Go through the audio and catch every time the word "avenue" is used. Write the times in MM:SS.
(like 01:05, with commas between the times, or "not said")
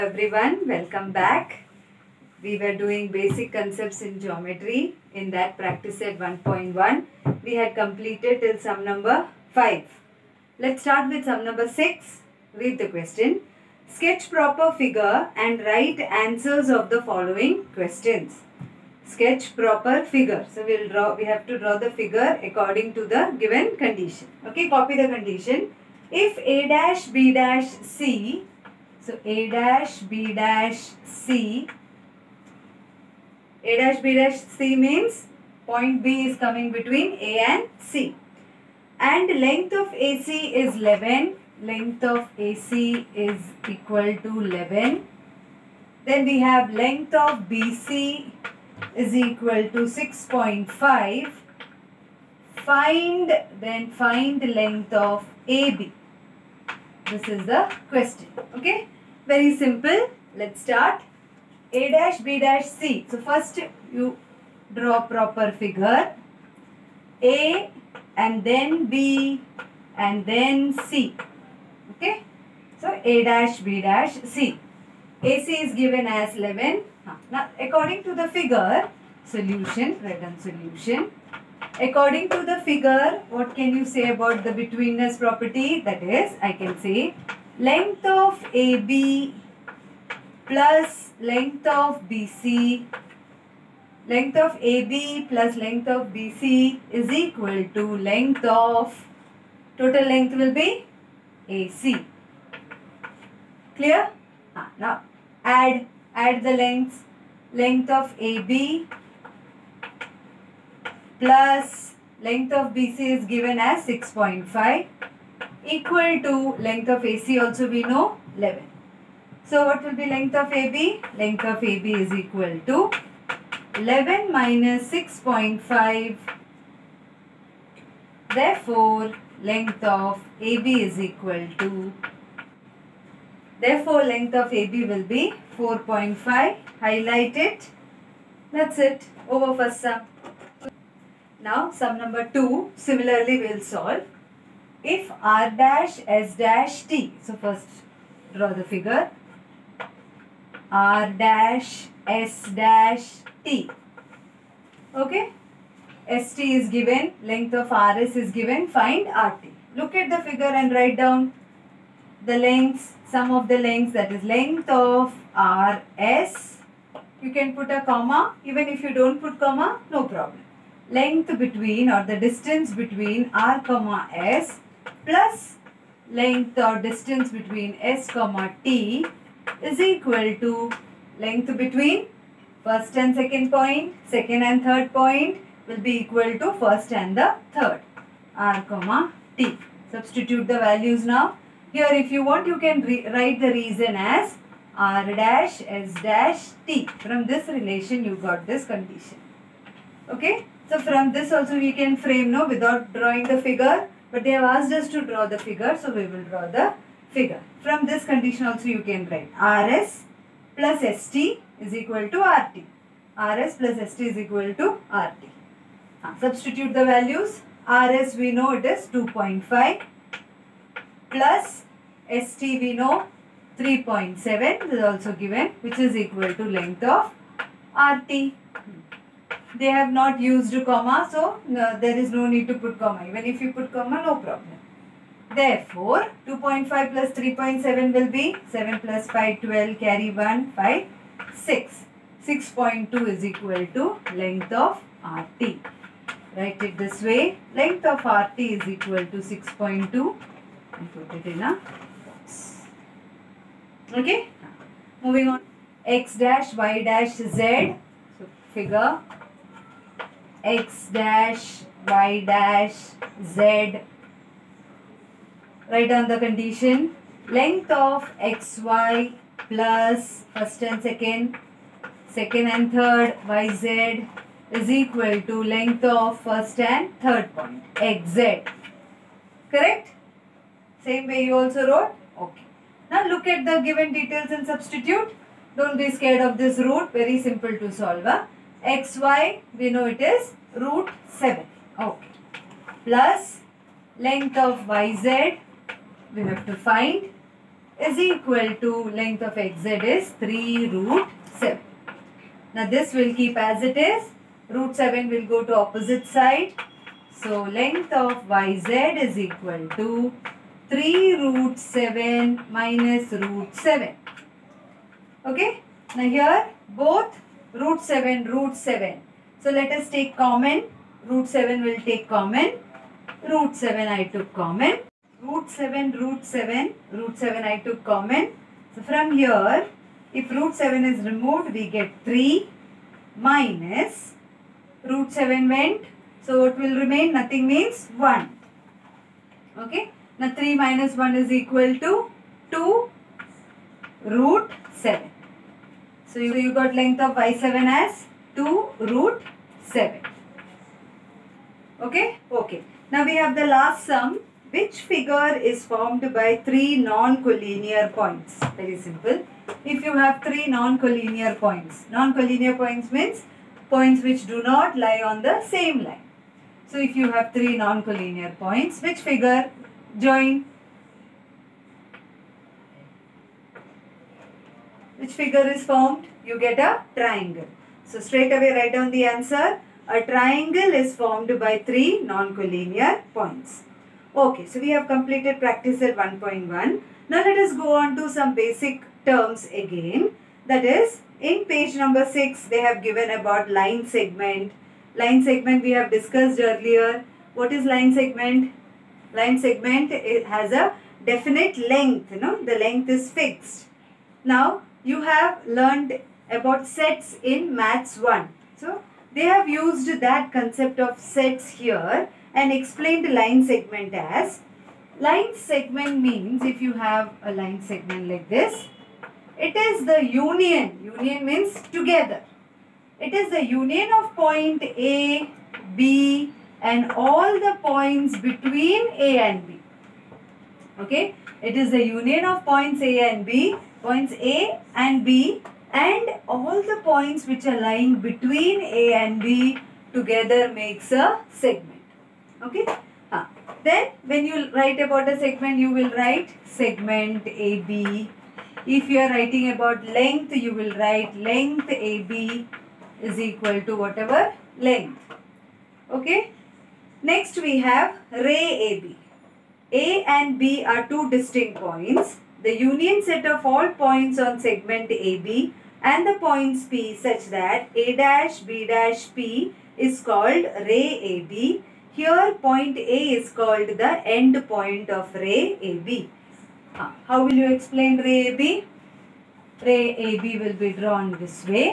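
not said.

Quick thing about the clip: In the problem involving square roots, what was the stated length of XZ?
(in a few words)
3 root 7.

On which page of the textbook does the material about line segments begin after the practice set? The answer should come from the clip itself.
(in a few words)
6.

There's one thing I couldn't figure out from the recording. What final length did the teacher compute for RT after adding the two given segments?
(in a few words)
6.2.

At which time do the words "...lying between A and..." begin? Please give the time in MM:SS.
07:17.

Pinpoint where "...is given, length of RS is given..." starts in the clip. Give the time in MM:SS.
02:36.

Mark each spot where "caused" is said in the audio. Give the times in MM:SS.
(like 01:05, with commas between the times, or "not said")
not said.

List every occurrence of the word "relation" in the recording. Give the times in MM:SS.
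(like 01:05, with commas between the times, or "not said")
03:17.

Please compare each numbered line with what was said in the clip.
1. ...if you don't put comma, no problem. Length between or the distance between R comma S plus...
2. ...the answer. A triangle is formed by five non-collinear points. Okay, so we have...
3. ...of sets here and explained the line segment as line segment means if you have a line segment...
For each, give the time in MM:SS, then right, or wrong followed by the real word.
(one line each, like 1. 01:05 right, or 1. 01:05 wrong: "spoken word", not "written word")
1. 02:48 right
2. 06:18 wrong: "three", not "five"
3. 06:50 right.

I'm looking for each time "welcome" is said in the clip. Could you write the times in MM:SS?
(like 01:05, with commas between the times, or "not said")
00:00.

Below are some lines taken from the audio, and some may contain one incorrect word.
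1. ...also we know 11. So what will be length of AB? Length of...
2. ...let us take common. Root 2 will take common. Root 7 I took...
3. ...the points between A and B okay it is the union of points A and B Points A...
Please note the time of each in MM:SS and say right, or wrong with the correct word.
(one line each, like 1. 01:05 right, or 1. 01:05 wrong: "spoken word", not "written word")
1. 01:57 right
2. 05:19 wrong: "7", not "2"
3. 07:07 right.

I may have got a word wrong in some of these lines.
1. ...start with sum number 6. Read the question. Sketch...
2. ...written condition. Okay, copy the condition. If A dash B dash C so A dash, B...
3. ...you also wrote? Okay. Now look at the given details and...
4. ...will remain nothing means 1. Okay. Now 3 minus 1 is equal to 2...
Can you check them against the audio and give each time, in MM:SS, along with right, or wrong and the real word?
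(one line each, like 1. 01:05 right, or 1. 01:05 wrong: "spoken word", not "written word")
1. 00:10 right
2. 00:23 wrong: "given", not "written"
3. 04:41 right
4. 05:36 right.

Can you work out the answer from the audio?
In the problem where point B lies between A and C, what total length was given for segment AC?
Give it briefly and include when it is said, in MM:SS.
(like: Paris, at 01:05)
11, at 00:41.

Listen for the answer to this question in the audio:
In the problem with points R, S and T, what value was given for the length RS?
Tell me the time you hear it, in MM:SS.
03:37.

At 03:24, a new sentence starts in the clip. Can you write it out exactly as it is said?
But they have asked us to draw the figure, so we will draw the figure.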